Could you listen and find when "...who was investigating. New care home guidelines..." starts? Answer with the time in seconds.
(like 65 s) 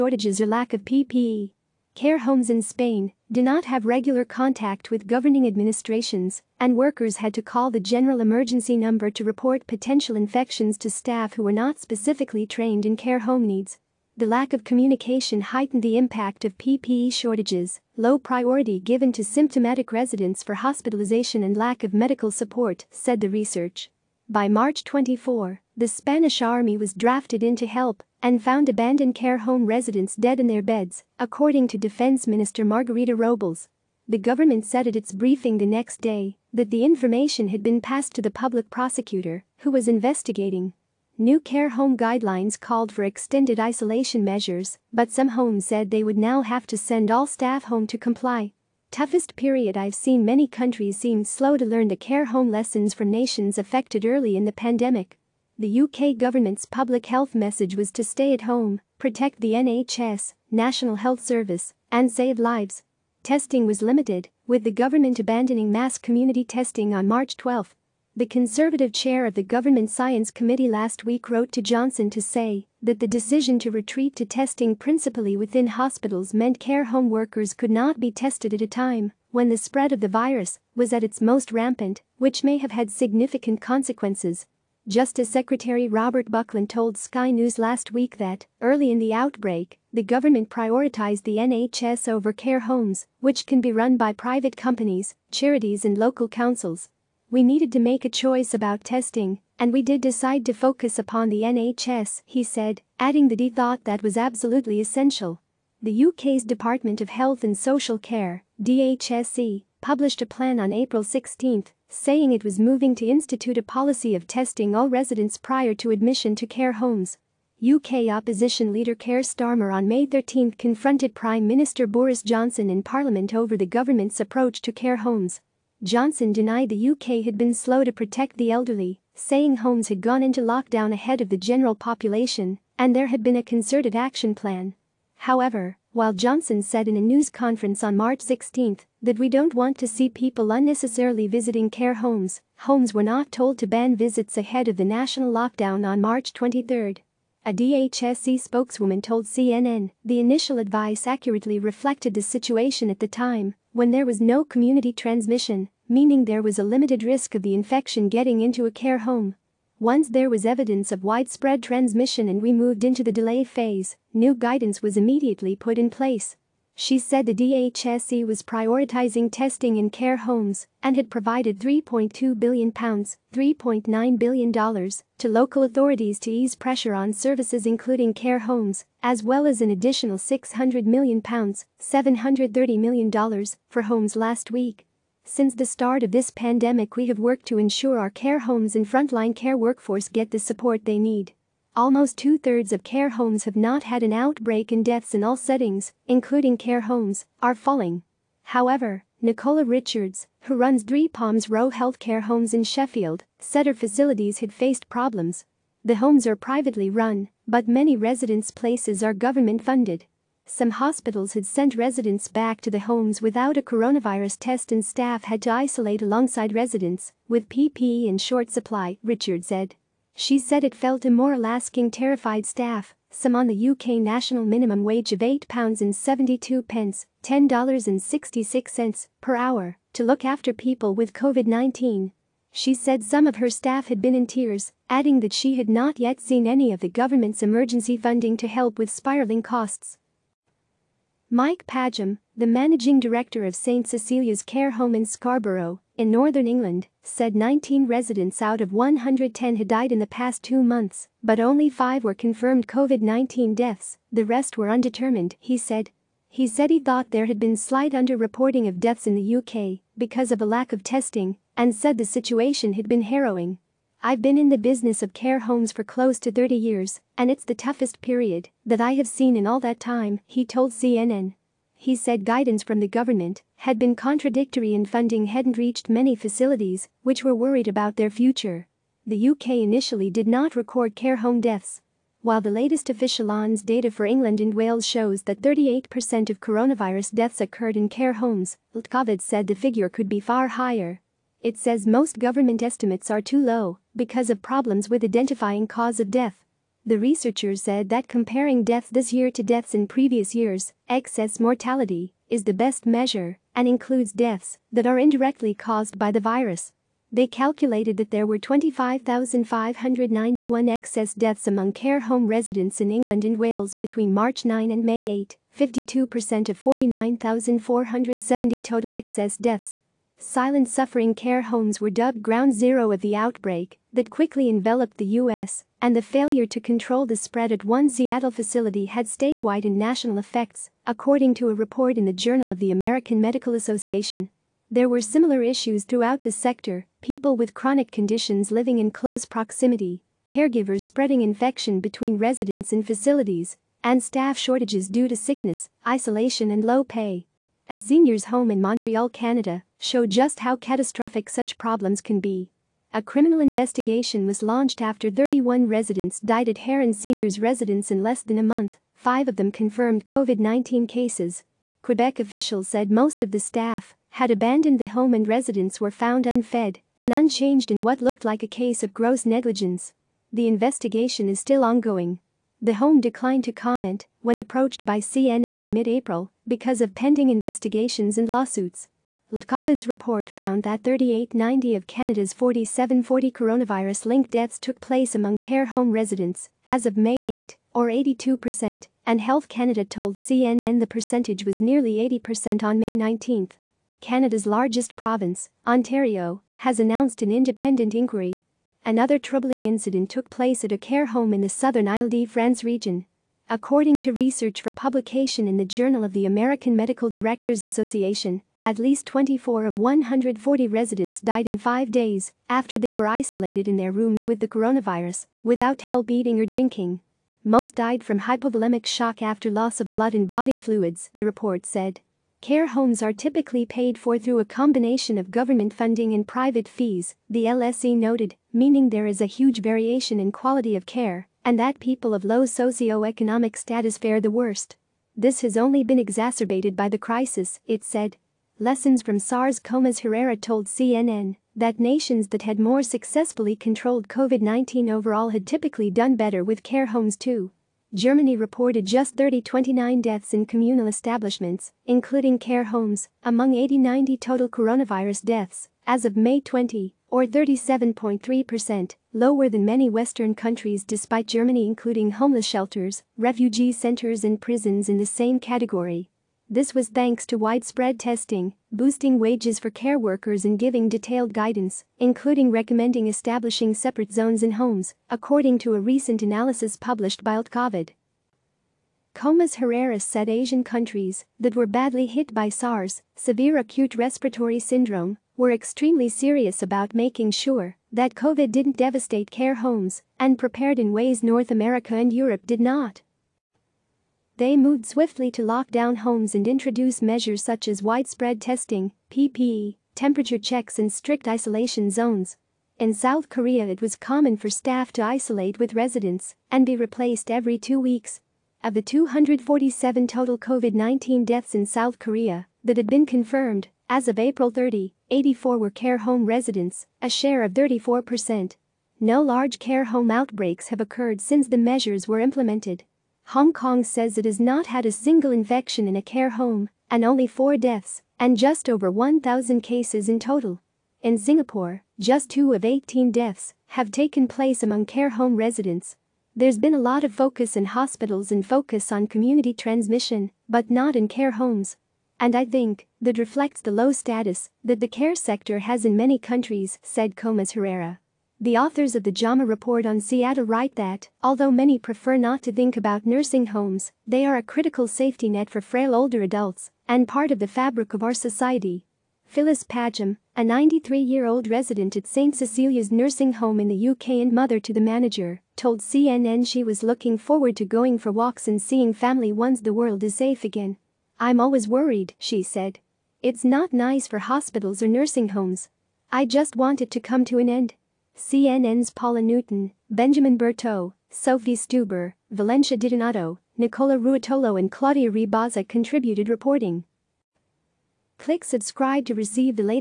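39 s.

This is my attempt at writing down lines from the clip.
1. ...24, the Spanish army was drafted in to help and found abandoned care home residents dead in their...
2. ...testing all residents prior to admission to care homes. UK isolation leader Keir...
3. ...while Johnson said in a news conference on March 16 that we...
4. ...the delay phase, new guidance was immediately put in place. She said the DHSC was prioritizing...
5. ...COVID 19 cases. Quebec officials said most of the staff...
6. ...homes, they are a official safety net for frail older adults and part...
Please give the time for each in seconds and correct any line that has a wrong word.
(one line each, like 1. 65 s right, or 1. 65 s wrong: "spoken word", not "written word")
1. 24 s right
2. 114 s wrong: "opposition", not "isolation"
3. 135 s right
4. 163 s right
5. 360 s right
6. 553 s wrong: "critical", not "official".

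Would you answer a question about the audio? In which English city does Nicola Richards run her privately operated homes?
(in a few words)
Sheffield.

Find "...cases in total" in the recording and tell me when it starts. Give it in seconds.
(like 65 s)
529 s.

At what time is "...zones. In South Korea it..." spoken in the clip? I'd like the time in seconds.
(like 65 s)
501 s.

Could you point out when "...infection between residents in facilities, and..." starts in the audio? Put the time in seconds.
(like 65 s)
341 s.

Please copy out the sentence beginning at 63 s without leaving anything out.
Testing was limited, with the government abandoning mass community testing on March 12.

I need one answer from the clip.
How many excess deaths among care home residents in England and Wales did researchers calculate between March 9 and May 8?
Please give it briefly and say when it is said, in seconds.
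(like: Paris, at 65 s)
25,591, at 308 s.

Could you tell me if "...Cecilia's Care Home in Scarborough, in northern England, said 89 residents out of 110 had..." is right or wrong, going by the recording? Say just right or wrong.
wrong.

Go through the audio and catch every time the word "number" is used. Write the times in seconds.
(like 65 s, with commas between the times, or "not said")
8 s.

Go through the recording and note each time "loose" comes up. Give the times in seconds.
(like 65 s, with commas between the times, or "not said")
not said.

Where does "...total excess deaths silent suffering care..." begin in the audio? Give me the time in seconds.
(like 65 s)
318 s.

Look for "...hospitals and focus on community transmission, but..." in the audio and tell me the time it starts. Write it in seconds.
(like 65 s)
537 s.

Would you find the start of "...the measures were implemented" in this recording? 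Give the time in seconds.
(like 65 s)
521 s.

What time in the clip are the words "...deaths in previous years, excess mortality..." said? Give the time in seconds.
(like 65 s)
299 s.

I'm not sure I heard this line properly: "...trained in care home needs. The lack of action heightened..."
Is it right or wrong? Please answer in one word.
wrong.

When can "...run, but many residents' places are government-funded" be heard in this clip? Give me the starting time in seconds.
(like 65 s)
206 s.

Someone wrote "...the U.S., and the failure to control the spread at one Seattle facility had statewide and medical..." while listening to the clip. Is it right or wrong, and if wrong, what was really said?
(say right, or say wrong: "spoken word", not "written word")
wrong: "national", not "medical".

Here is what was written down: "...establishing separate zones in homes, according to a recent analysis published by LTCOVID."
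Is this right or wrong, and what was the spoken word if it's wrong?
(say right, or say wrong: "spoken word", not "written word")
right.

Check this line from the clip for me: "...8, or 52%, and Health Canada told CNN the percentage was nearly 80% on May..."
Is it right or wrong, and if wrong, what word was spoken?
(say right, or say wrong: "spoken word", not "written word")
wrong: "82", not "52".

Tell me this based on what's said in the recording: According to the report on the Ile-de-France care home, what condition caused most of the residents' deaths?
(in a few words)
hypovolemic shock.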